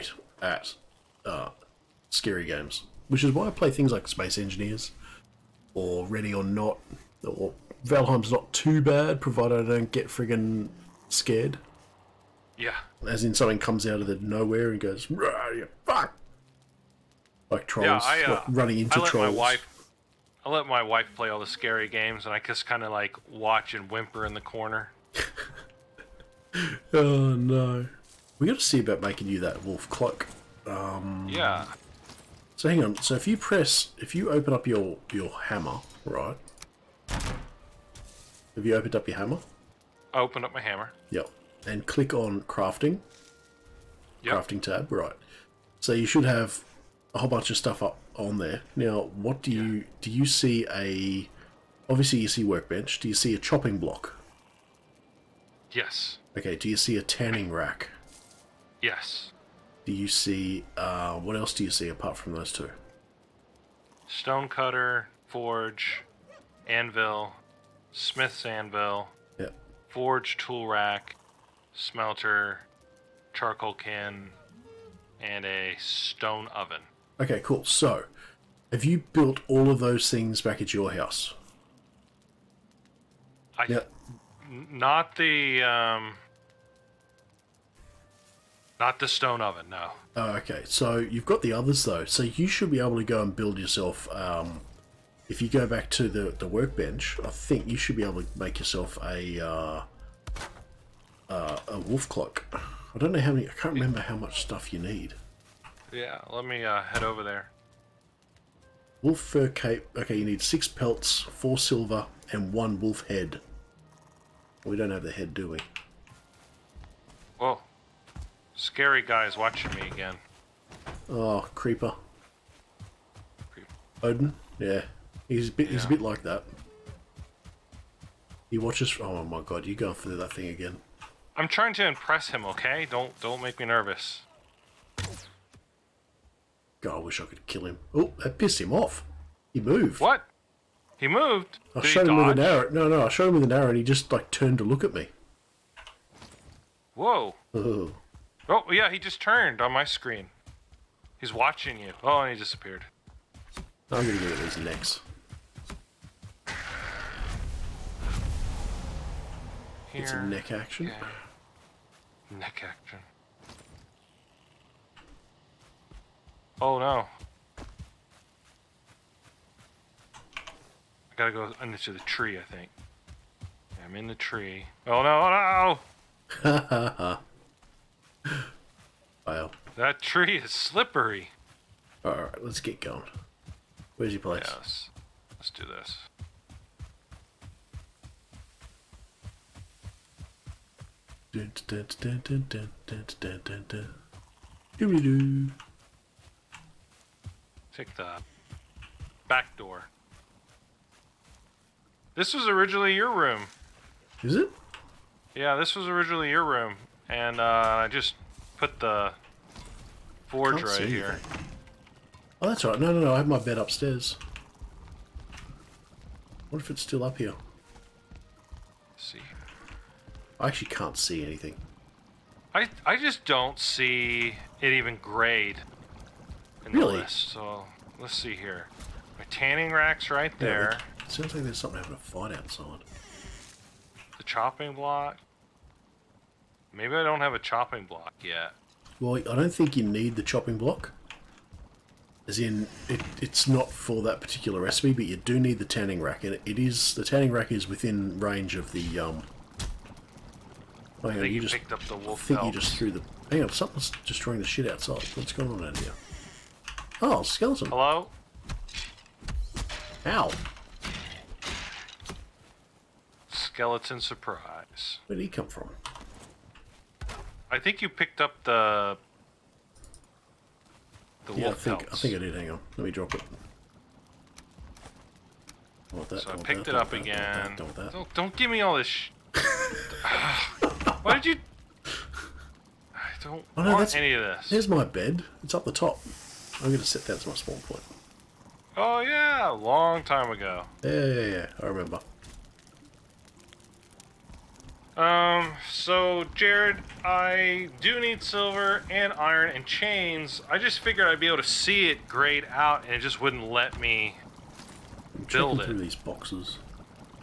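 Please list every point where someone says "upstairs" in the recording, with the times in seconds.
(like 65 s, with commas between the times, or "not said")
213 s.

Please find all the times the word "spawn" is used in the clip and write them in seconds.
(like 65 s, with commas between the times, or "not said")
287 s.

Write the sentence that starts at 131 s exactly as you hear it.
I'm trying to impress him, okay?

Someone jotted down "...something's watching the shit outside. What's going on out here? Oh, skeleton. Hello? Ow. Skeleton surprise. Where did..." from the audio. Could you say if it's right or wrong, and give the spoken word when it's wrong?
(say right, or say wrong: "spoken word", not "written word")
wrong: "destroying", not "watching".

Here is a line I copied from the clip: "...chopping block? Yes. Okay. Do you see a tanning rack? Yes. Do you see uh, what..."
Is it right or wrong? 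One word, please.
right.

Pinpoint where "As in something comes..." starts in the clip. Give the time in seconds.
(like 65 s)
13 s.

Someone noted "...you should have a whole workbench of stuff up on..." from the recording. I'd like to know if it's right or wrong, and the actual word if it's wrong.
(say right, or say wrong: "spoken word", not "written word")
wrong: "bunch", not "workbench".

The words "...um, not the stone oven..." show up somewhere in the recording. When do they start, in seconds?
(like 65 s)
85 s.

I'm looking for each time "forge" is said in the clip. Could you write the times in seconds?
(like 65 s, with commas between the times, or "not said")
65 s, 69 s, 210 s.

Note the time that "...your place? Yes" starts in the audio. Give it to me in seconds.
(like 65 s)
184 s.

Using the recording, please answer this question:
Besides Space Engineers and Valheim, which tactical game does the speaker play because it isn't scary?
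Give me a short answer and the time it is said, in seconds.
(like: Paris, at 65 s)
Ready or Not, at 6 s.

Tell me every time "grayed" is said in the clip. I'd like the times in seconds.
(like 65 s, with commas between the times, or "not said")
225 s, 302 s.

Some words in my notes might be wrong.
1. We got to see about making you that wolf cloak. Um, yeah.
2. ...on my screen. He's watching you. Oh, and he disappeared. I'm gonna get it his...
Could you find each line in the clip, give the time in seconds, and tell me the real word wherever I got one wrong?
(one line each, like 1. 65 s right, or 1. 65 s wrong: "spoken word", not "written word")
1. 28 s right
2. 149 s right.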